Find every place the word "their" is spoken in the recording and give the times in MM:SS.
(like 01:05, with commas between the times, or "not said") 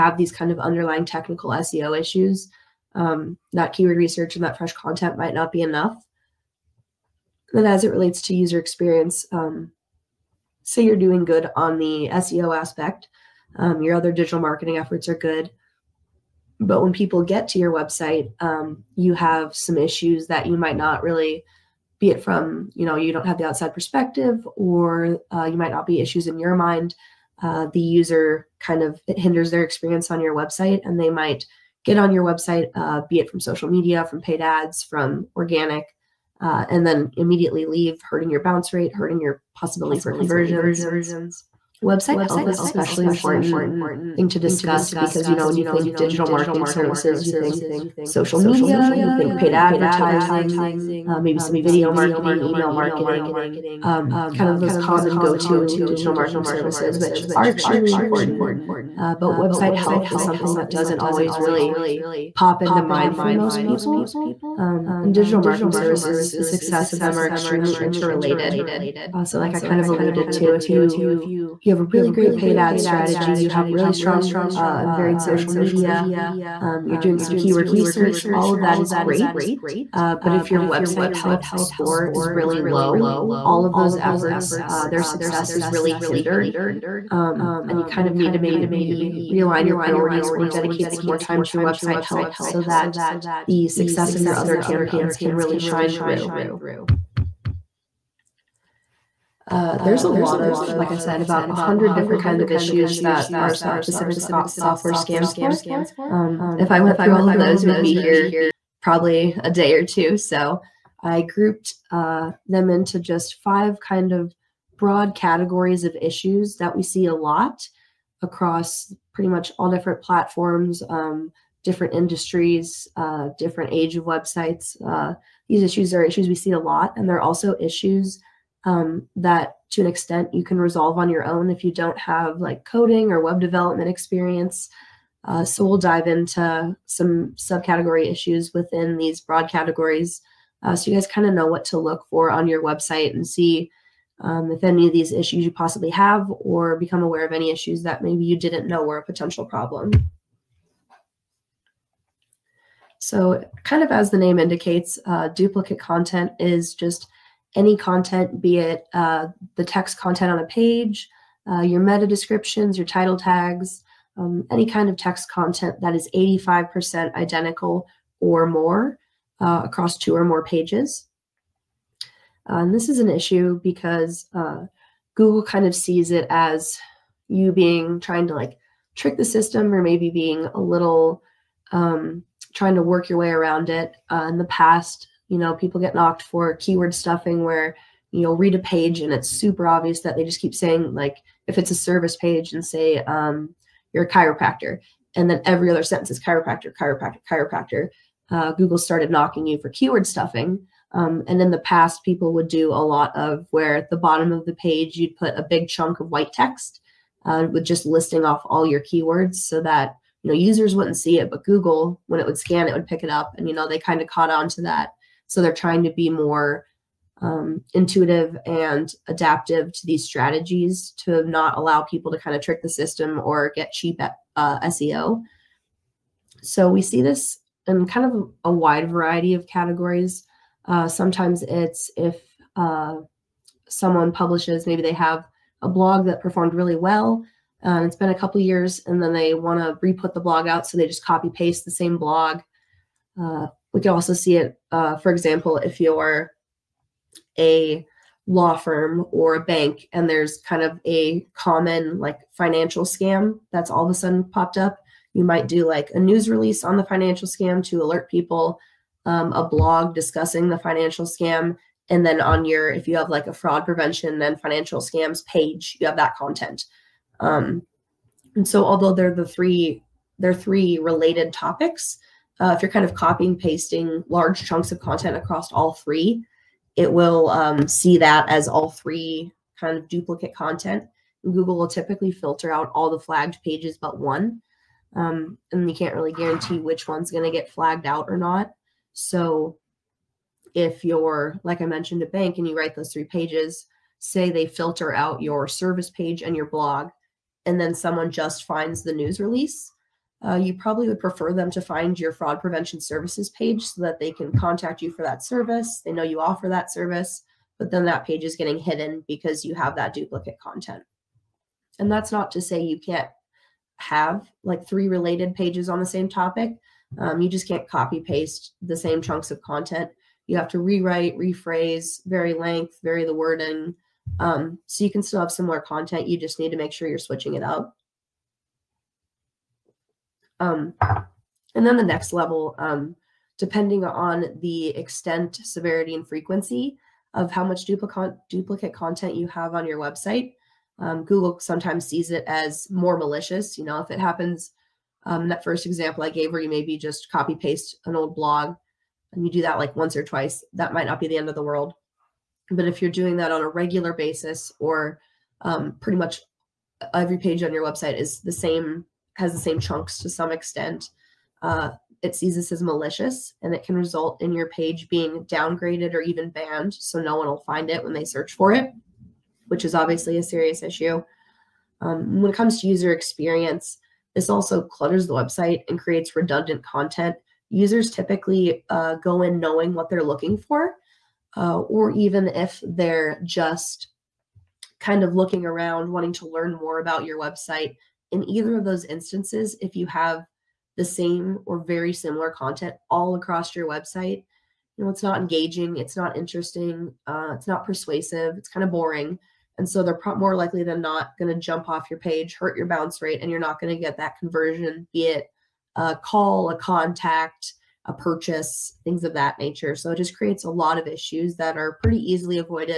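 00:29, 01:24.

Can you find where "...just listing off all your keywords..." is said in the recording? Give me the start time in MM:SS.
03:27.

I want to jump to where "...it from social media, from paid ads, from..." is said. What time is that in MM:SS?
00:33.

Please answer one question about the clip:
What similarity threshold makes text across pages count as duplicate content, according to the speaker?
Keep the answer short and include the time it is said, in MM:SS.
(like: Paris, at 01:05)
85%, at 02:46.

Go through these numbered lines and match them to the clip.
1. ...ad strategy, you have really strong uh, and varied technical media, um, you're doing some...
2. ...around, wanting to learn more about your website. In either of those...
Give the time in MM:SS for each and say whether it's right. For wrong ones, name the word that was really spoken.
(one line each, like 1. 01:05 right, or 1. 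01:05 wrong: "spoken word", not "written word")
1. 01:12 wrong: "social", not "technical"
2. 06:25 right.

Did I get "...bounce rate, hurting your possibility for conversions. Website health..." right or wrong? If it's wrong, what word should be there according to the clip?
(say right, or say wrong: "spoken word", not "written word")
right.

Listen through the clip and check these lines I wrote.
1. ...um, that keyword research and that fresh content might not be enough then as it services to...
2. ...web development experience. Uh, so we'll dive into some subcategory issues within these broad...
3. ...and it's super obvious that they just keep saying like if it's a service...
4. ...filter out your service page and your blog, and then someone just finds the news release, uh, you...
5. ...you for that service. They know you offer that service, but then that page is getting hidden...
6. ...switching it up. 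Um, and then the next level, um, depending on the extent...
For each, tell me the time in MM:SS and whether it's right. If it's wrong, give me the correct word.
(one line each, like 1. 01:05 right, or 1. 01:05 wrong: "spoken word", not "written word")
1. 00:02 wrong: "relates", not "services"
2. 02:13 right
3. 03:08 right
4. 04:54 right
5. 05:04 right
6. 05:26 right.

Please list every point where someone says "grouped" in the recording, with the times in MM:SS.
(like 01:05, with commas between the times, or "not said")
01:51.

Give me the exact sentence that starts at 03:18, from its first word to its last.
Uh, Google started knocking you for keyword stuffing.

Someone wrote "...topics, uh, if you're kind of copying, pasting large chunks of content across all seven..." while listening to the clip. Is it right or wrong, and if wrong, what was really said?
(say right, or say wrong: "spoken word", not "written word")
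wrong: "three", not "seven".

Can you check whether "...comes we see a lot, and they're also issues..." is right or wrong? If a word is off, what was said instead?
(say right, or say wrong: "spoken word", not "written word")
wrong: "issues", not "comes".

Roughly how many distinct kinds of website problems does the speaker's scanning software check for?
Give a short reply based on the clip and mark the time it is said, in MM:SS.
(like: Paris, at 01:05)
100, at 01:41.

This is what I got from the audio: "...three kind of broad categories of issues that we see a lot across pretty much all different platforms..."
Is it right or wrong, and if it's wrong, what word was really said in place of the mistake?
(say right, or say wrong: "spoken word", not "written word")
wrong: "five", not "three".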